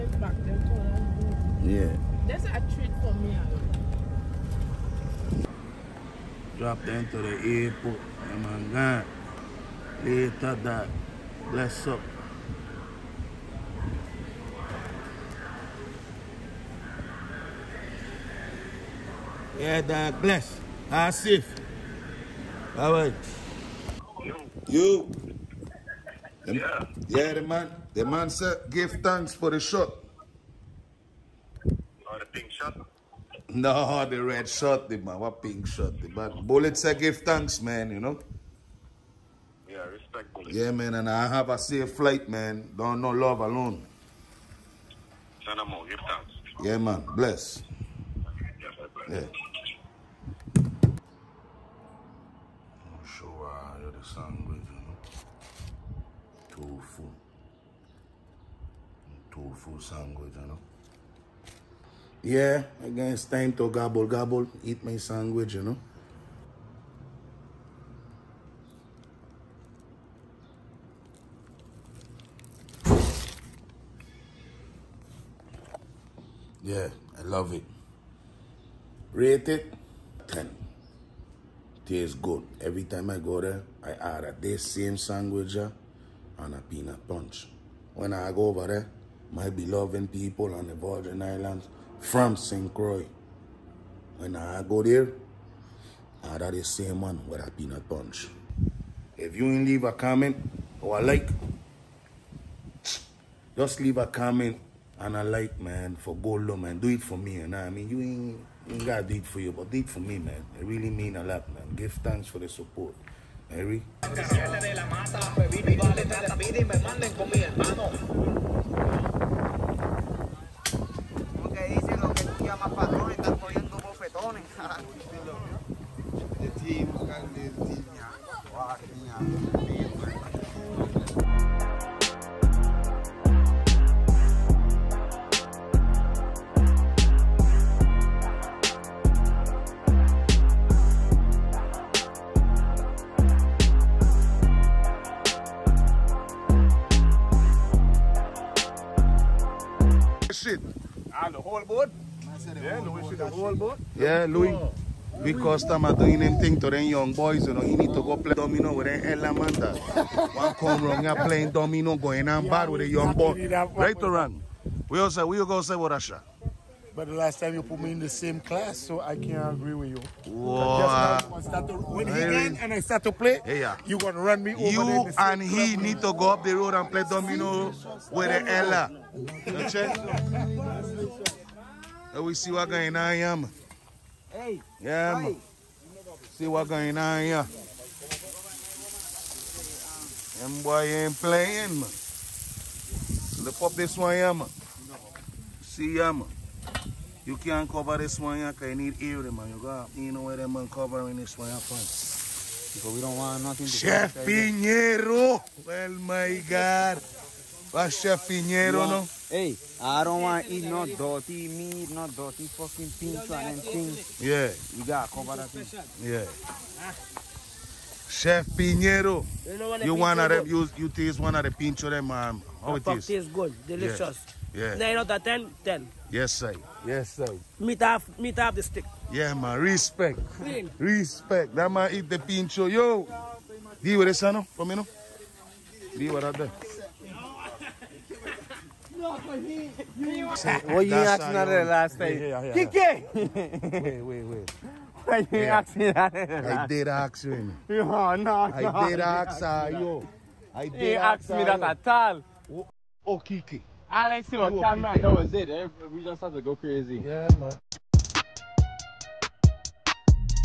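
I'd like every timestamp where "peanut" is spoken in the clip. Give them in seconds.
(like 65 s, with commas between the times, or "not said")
86 s, 97 s.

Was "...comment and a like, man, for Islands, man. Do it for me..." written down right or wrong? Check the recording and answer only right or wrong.
wrong.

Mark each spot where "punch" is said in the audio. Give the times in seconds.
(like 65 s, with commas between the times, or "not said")
87 s, 97 s.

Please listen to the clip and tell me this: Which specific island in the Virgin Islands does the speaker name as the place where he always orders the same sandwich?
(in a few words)
St. Croix.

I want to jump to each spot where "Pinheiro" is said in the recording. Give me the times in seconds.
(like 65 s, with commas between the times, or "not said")
208 s, 218 s.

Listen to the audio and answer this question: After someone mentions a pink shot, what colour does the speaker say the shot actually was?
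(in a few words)
Red.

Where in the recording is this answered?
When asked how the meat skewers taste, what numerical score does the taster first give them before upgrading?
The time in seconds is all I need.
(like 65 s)
224 s.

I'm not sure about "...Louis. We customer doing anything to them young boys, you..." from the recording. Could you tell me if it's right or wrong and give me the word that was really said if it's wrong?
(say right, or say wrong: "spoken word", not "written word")
right.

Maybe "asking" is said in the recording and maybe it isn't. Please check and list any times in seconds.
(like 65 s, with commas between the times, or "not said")
240 s, 245 s.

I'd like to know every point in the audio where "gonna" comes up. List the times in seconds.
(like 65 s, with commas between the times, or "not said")
173 s.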